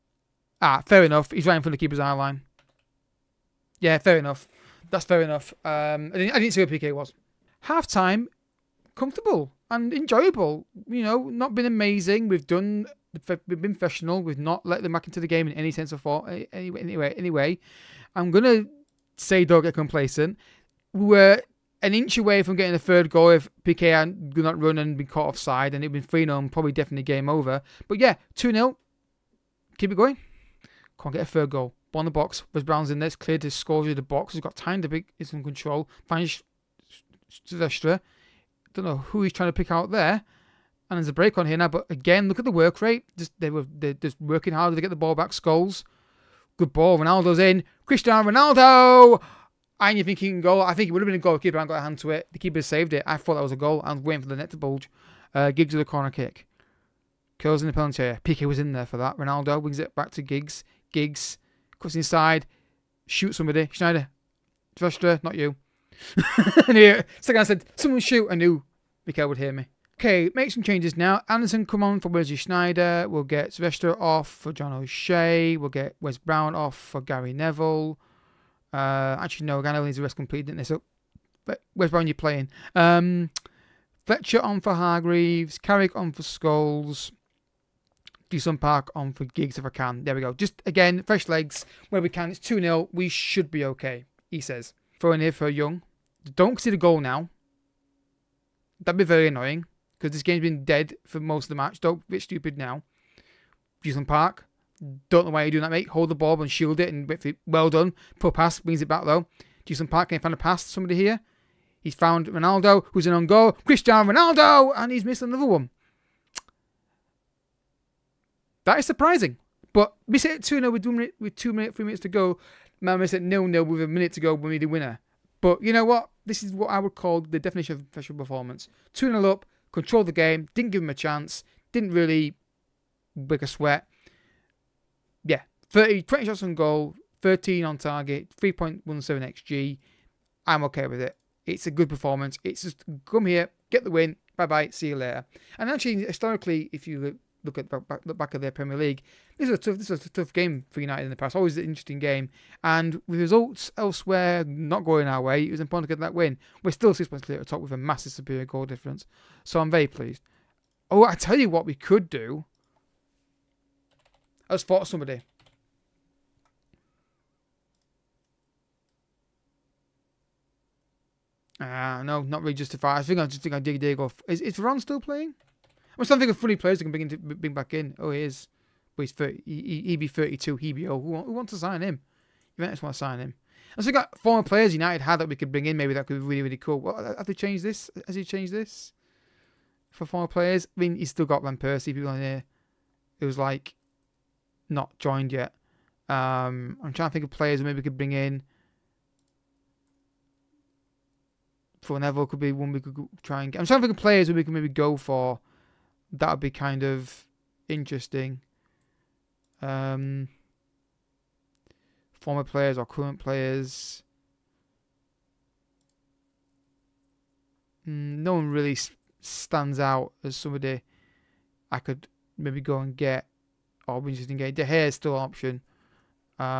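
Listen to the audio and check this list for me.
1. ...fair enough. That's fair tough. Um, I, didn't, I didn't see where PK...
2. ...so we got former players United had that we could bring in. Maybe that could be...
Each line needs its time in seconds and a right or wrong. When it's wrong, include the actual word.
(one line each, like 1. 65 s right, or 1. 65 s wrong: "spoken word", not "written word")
1. 3 s wrong: "enough", not "tough"
2. 183 s right.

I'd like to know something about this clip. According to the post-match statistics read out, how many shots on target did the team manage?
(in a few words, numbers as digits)
13.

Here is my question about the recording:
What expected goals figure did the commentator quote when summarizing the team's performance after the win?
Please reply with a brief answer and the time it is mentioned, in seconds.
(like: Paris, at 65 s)
3.17, at 138 s.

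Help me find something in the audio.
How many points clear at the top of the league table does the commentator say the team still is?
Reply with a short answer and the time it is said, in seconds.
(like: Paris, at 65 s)
6, at 156 s.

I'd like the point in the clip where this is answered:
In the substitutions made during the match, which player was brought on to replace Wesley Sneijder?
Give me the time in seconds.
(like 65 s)
71 s.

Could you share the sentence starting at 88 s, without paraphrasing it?
Jisung Park on for Giggs if I can.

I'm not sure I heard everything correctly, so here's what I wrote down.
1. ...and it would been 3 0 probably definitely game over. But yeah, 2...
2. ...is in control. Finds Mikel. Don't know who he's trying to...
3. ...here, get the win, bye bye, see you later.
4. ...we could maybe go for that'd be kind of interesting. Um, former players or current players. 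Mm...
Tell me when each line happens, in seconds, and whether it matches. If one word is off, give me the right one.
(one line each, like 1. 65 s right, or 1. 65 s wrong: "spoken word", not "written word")
1. 25 s right
2. 35 s wrong: "Silvestre", not "Mikel"
3. 143 s right
4. 204 s right.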